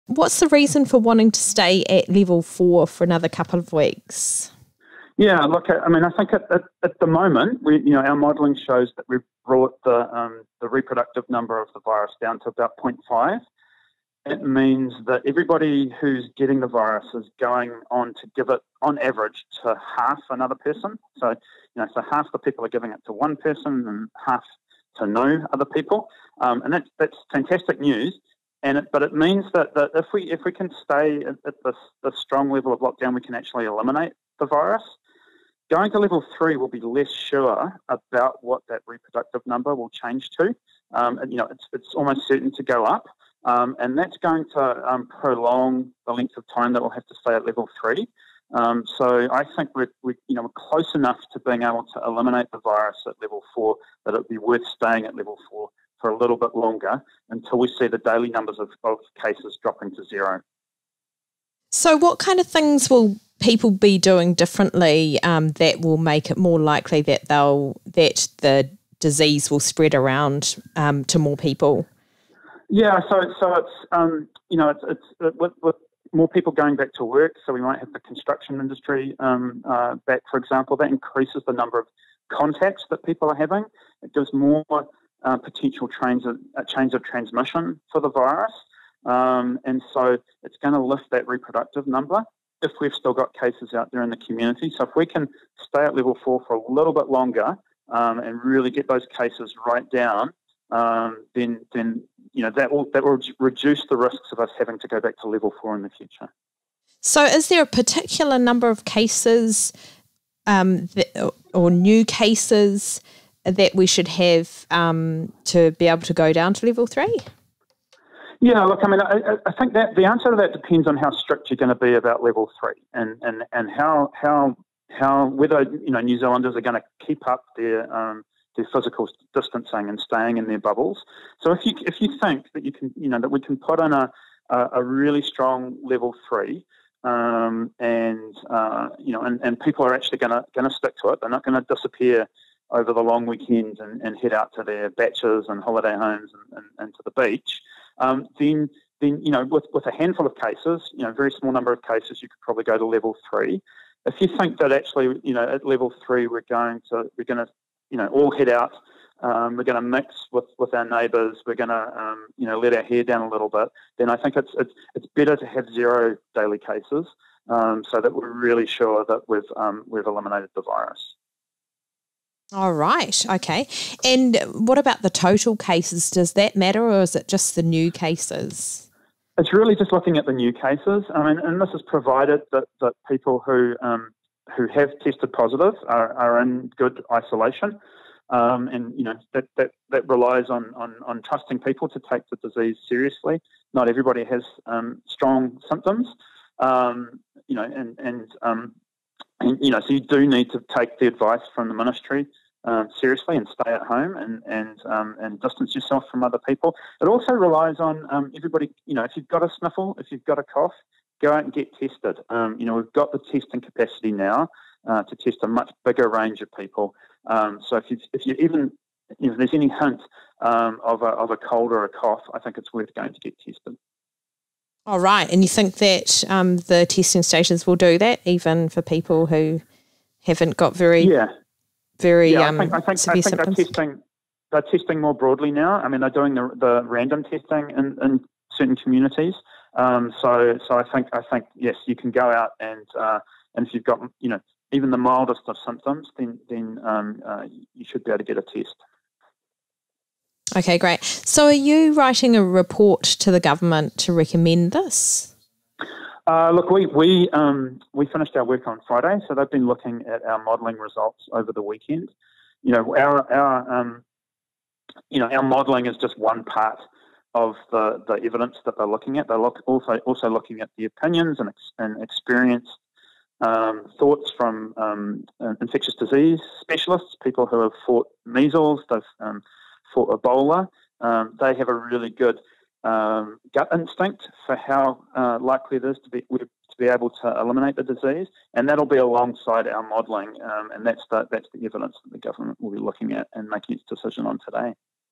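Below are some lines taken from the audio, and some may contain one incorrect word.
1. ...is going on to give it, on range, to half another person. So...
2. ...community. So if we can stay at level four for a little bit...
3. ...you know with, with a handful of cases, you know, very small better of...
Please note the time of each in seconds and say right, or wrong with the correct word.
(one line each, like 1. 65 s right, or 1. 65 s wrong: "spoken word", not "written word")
1. 17 s wrong: "average", not "range"
2. 94 s right
3. 149 s wrong: "number", not "better".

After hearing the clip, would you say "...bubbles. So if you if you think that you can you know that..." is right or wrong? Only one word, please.
right.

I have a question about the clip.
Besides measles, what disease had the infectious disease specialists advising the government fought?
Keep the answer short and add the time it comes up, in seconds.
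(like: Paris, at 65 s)
Ebola, at 280 s.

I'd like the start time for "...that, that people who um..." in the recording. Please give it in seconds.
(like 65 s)
182 s.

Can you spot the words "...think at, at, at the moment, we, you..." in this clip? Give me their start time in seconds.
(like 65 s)
6 s.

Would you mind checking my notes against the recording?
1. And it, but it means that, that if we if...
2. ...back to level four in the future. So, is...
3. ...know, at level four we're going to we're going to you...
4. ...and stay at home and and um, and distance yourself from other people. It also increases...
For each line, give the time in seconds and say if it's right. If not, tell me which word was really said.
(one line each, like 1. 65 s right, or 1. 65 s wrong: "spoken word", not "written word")
1. 28 s right
2. 105 s right
3. 155 s wrong: "three", not "four"
4. 203 s wrong: "relies", not "increases".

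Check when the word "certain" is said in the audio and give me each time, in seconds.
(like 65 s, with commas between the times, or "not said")
42 s, 238 s.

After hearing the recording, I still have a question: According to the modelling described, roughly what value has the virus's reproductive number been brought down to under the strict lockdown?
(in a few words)
0.5.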